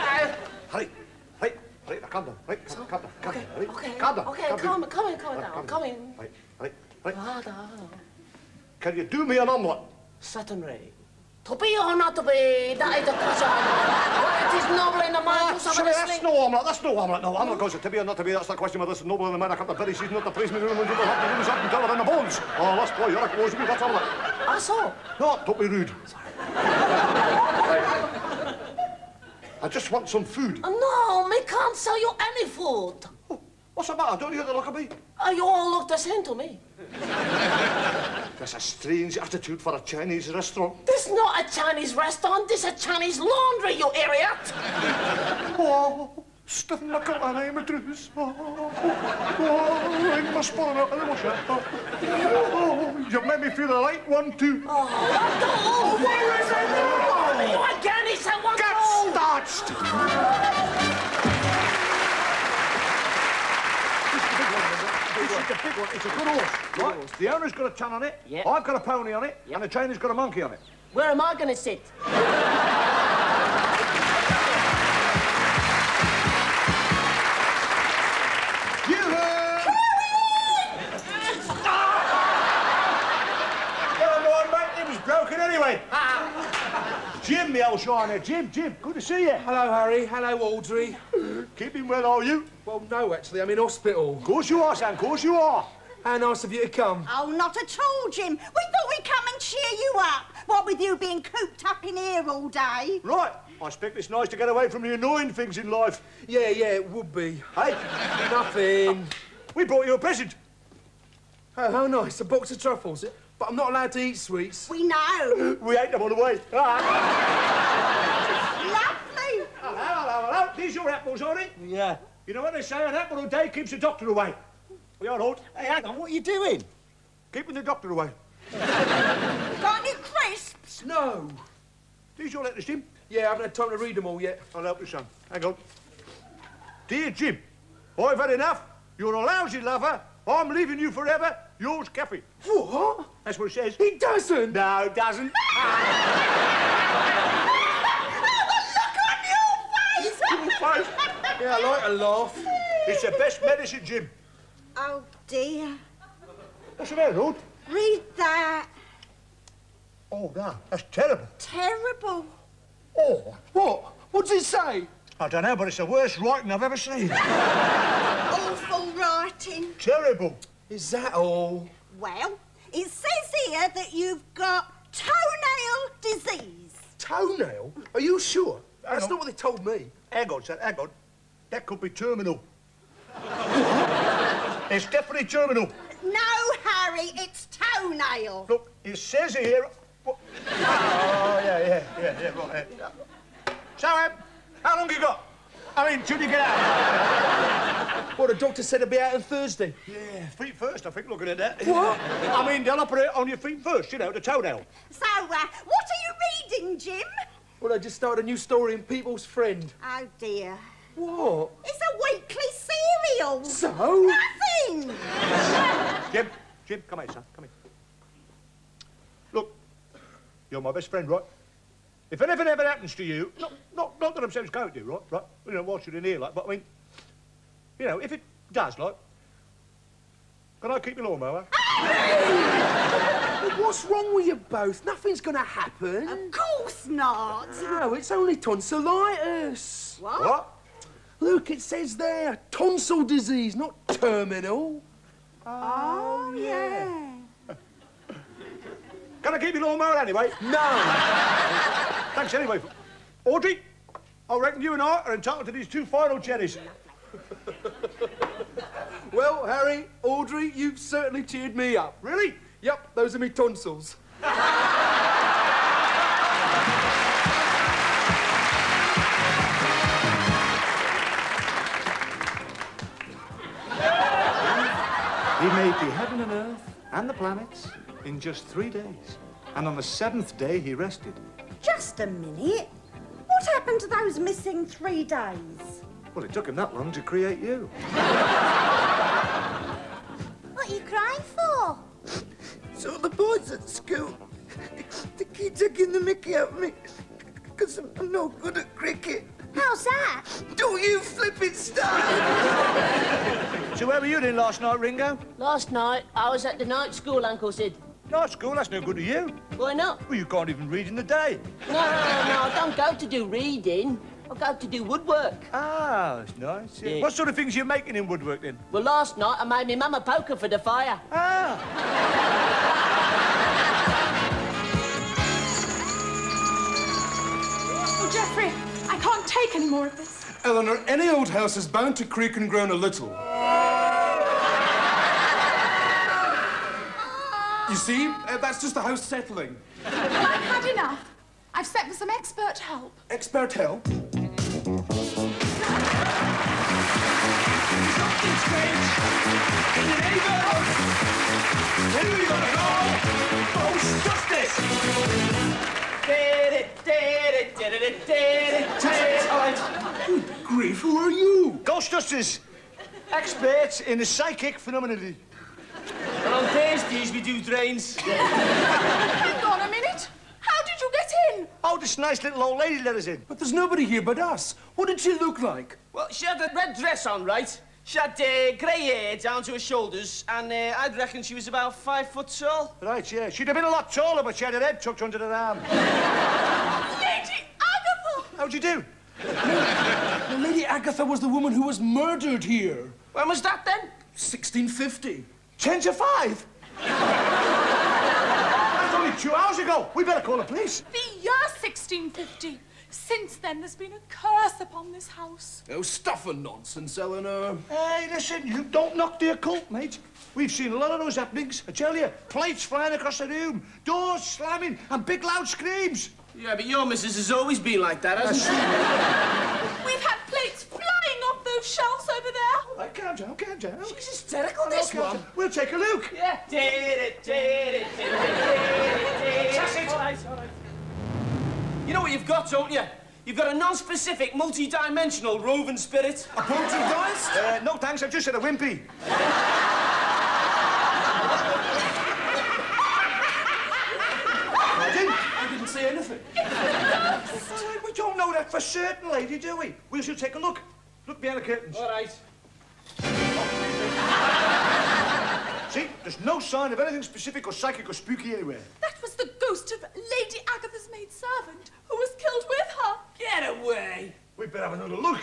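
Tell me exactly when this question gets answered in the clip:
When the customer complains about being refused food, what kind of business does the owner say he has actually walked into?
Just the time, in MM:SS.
00:42.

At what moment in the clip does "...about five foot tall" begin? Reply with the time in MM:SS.
06:21.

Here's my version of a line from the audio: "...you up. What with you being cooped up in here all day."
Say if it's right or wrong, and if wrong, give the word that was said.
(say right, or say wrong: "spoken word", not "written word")
right.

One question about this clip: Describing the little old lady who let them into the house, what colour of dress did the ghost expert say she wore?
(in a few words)
red.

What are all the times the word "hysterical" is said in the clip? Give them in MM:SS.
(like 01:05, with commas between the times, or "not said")
07:04.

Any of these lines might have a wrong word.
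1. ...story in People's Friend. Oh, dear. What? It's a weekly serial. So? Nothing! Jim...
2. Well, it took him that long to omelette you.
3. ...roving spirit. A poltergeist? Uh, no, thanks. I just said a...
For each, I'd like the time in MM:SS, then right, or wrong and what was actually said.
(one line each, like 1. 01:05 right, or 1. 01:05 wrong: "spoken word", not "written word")
1. 03:28 right
2. 04:46 wrong: "create", not "omelette"
3. 07:15 right.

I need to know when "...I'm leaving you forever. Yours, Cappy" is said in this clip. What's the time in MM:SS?
02:20.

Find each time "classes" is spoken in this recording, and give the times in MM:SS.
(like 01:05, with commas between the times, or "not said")
not said.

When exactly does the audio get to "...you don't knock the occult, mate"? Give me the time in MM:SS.
06:48.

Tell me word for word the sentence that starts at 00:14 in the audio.
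Whether it is noble in the man who's having a That's no omelette, that's no omelette, no.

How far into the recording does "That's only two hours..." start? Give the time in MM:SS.
06:36.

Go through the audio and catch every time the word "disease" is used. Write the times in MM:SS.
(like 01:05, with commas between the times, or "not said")
02:56, 04:03.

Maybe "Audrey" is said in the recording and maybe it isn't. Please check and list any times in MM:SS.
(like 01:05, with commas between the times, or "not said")
01:30, 04:13, 04:20.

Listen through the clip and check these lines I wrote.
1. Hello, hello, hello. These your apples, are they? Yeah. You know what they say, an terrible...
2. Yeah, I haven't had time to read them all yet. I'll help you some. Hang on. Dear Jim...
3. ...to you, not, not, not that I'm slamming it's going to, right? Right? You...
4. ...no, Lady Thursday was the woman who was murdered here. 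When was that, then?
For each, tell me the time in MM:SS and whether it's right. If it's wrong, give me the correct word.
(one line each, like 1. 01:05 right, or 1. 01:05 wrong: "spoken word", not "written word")
1. 01:59 wrong: "apple", not "terrible"
2. 02:13 right
3. 03:42 wrong: "saying", not "slamming"
4. 06:30 wrong: "Agatha", not "Thursday".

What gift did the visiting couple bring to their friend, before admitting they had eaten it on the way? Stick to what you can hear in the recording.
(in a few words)
box of truffles.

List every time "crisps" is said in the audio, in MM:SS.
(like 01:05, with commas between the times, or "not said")
02:09.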